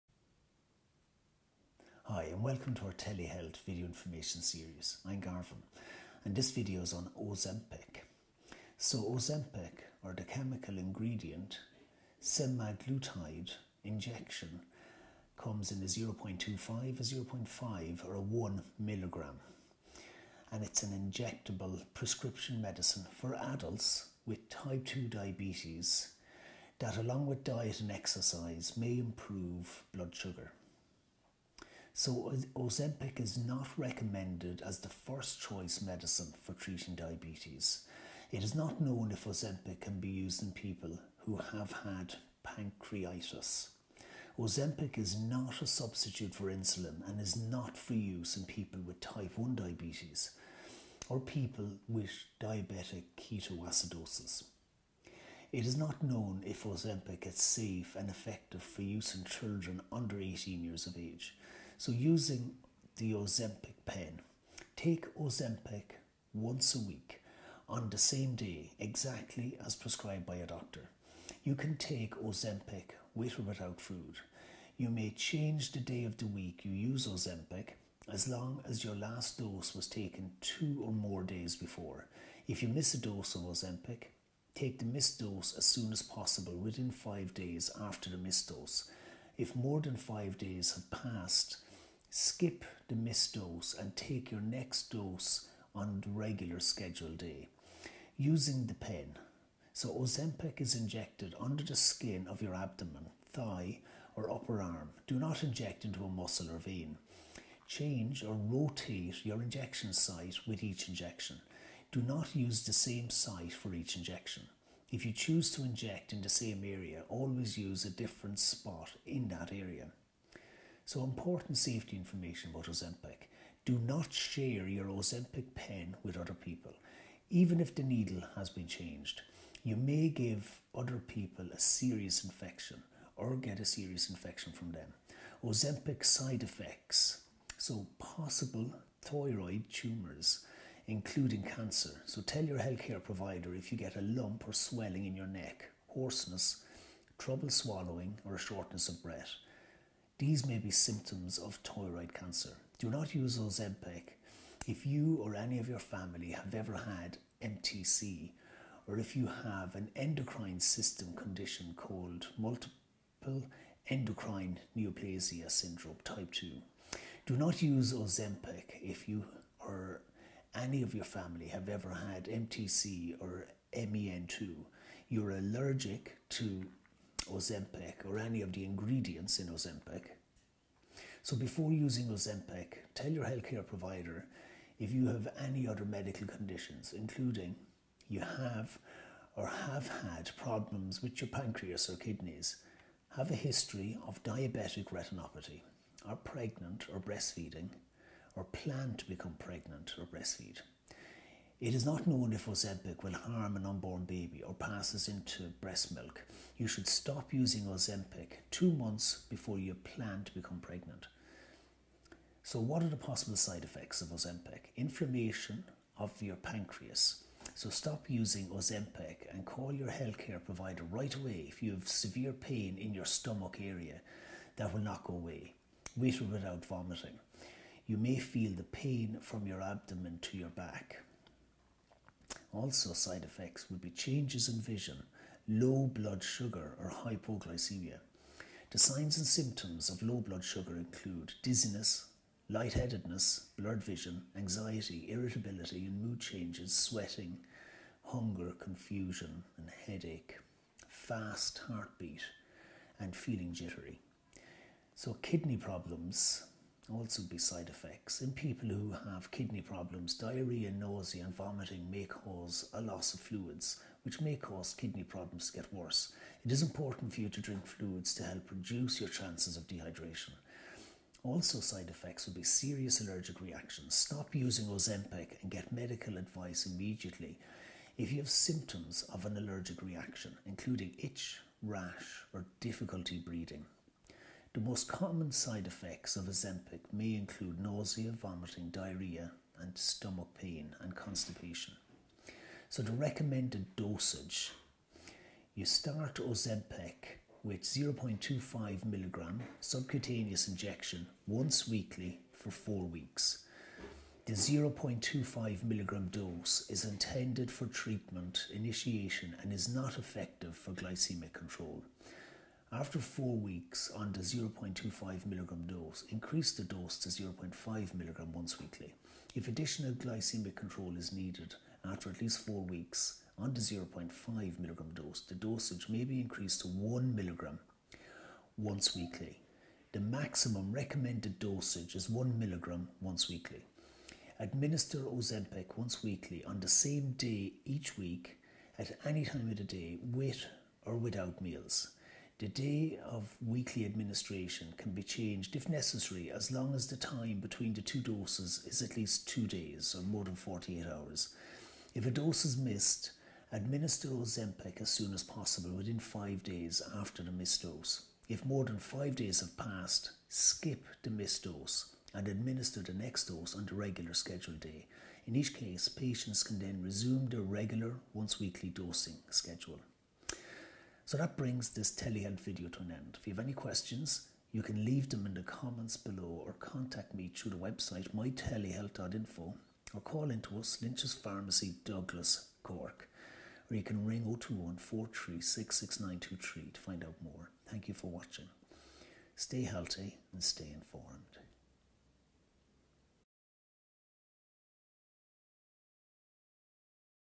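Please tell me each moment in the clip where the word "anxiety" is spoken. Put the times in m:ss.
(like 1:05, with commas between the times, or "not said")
4:04.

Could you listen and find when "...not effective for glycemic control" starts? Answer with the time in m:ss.
5:09.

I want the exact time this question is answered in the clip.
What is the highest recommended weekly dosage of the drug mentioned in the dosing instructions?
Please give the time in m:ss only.
5:32.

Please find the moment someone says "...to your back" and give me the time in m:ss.
3:50.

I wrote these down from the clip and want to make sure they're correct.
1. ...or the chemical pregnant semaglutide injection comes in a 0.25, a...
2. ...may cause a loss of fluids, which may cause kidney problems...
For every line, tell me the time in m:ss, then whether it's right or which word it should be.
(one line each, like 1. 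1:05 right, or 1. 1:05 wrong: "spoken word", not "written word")
1. 0:10 wrong: "ingredient", not "pregnant"
2. 4:21 right.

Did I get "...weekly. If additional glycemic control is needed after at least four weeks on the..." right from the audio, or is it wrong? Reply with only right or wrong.
right.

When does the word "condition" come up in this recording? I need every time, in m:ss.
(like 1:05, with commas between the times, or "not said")
2:41, 3:06.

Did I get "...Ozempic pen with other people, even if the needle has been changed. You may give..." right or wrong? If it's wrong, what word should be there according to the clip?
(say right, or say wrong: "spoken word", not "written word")
right.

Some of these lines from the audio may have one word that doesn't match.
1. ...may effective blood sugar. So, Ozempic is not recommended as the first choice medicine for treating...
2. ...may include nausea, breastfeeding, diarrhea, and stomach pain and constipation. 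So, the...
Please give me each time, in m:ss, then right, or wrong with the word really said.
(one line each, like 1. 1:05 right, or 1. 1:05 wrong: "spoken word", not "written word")
1. 0:28 wrong: "improve", not "effective"
2. 4:46 wrong: "vomiting", not "breastfeeding".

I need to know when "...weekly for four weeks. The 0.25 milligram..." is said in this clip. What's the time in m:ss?
5:01.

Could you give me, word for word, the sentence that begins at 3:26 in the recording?
You should stop using Ozempic two months before you plan to become pregnant.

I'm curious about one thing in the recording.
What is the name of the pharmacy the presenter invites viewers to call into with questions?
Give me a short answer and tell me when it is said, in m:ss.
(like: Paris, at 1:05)
Lynch's Pharmacy, at 6:20.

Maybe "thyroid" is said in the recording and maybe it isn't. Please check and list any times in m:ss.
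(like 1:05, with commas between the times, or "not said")
2:19, 2:31.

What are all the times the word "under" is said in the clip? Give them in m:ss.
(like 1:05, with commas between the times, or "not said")
0:59, 1:41.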